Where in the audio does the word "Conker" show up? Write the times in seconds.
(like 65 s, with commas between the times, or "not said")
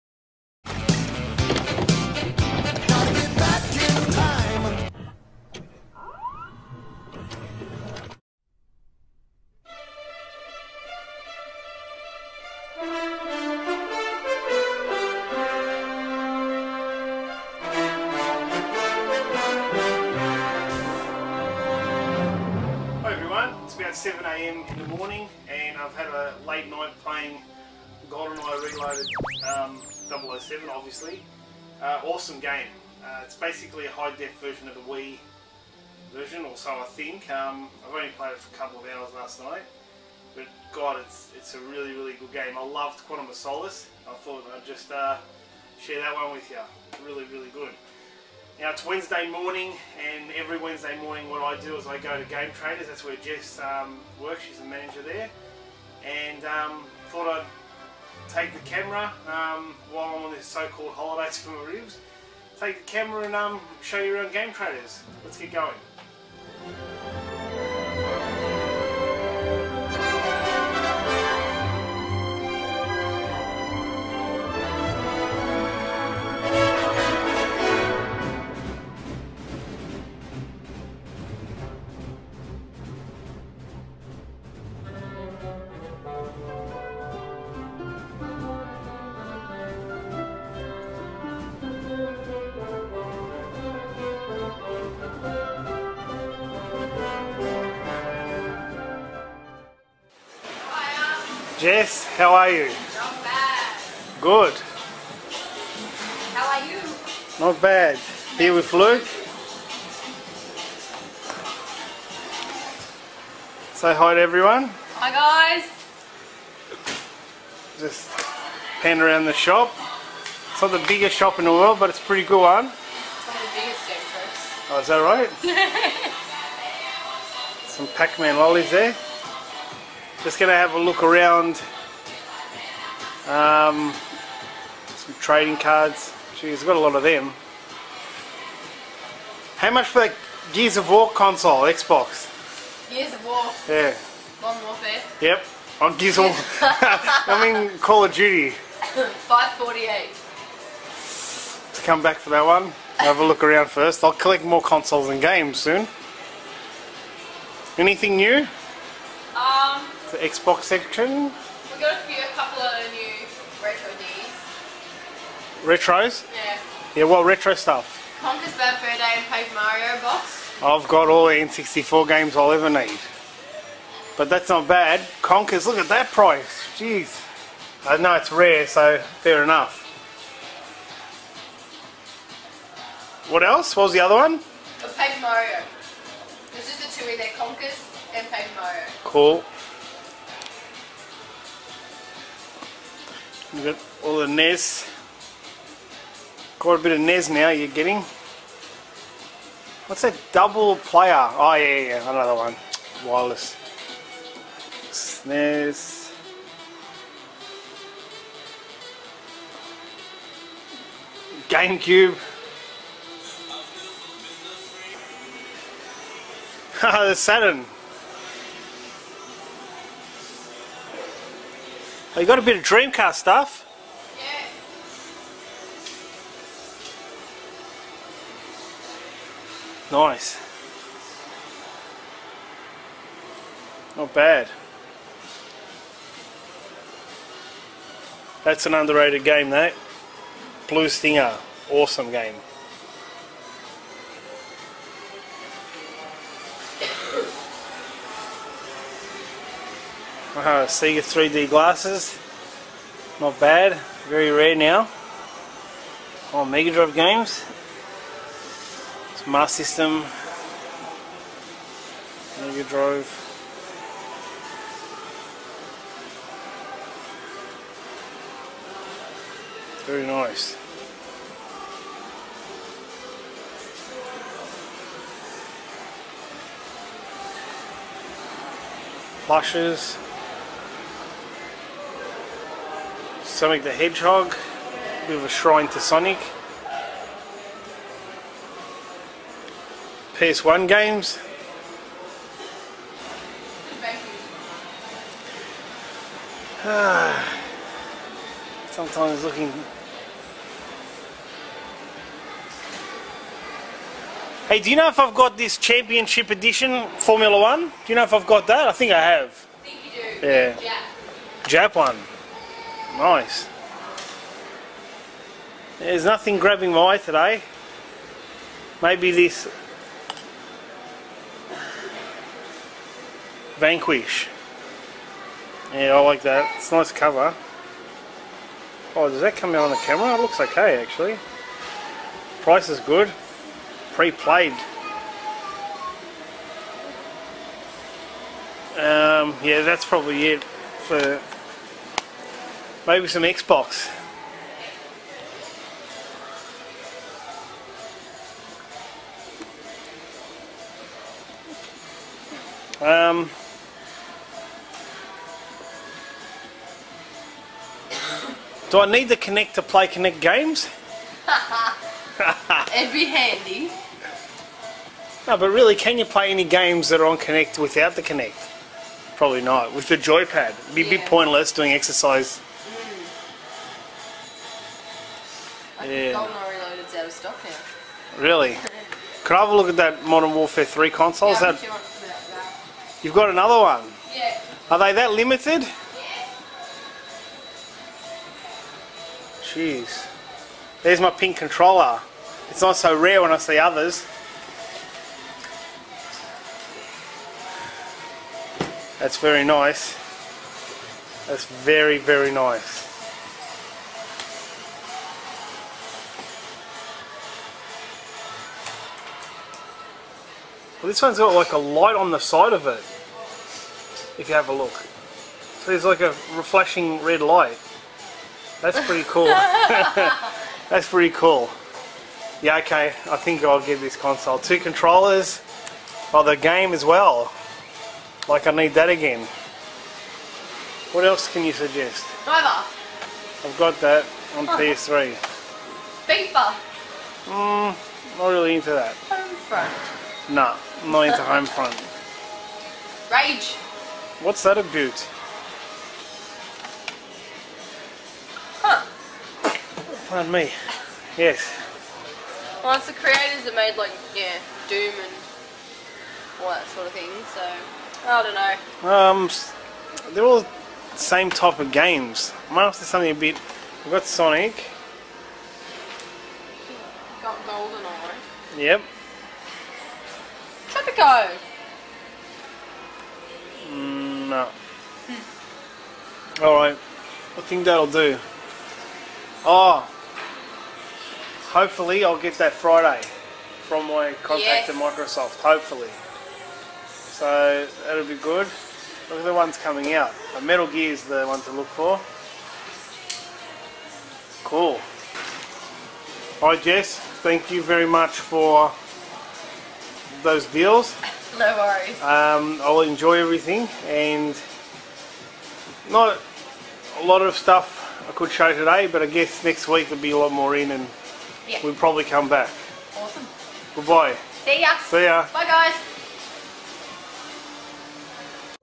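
168 s, 175 s, 187 s.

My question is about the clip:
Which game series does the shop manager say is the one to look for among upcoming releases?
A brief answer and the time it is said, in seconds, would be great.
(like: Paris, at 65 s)
Metal Gear, at 490 s.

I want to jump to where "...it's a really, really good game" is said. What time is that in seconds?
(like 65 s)
41 s.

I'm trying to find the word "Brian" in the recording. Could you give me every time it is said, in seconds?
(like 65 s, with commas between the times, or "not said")
not said.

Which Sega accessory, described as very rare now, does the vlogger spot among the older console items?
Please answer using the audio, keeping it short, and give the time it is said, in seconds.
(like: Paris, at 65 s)
Sega 3D glasses, at 250 s.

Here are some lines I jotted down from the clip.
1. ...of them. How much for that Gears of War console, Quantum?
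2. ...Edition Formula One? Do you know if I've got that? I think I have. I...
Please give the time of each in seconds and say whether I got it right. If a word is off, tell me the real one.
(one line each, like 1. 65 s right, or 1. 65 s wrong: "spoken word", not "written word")
1. 136 s wrong: "Xbox", not "Quantum"
2. 306 s right.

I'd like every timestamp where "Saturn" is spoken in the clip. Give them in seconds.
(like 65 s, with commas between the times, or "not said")
217 s.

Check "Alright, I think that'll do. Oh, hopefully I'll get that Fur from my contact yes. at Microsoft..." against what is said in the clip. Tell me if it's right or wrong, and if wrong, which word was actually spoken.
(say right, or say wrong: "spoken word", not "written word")
wrong: "Friday", not "Fur".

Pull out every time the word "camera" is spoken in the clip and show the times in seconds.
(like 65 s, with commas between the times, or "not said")
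58 s, 62 s, 329 s.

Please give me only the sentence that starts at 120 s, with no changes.
It's not the biggest shop in the world, but it's a pretty good one.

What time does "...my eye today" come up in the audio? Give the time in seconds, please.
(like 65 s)
316 s.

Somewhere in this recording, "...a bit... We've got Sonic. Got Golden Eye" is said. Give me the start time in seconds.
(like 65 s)
463 s.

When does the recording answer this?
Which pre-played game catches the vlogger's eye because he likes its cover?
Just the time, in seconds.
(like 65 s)
323 s.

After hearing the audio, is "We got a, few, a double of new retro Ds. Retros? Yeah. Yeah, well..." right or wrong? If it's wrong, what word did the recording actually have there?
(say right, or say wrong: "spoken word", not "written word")
wrong: "couple", not "double".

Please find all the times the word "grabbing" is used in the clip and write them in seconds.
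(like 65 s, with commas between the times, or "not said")
316 s.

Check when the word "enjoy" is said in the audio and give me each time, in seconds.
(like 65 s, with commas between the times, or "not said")
502 s.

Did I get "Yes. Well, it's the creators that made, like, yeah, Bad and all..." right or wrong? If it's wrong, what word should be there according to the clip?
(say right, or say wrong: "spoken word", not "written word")
wrong: "Doom", not "Bad".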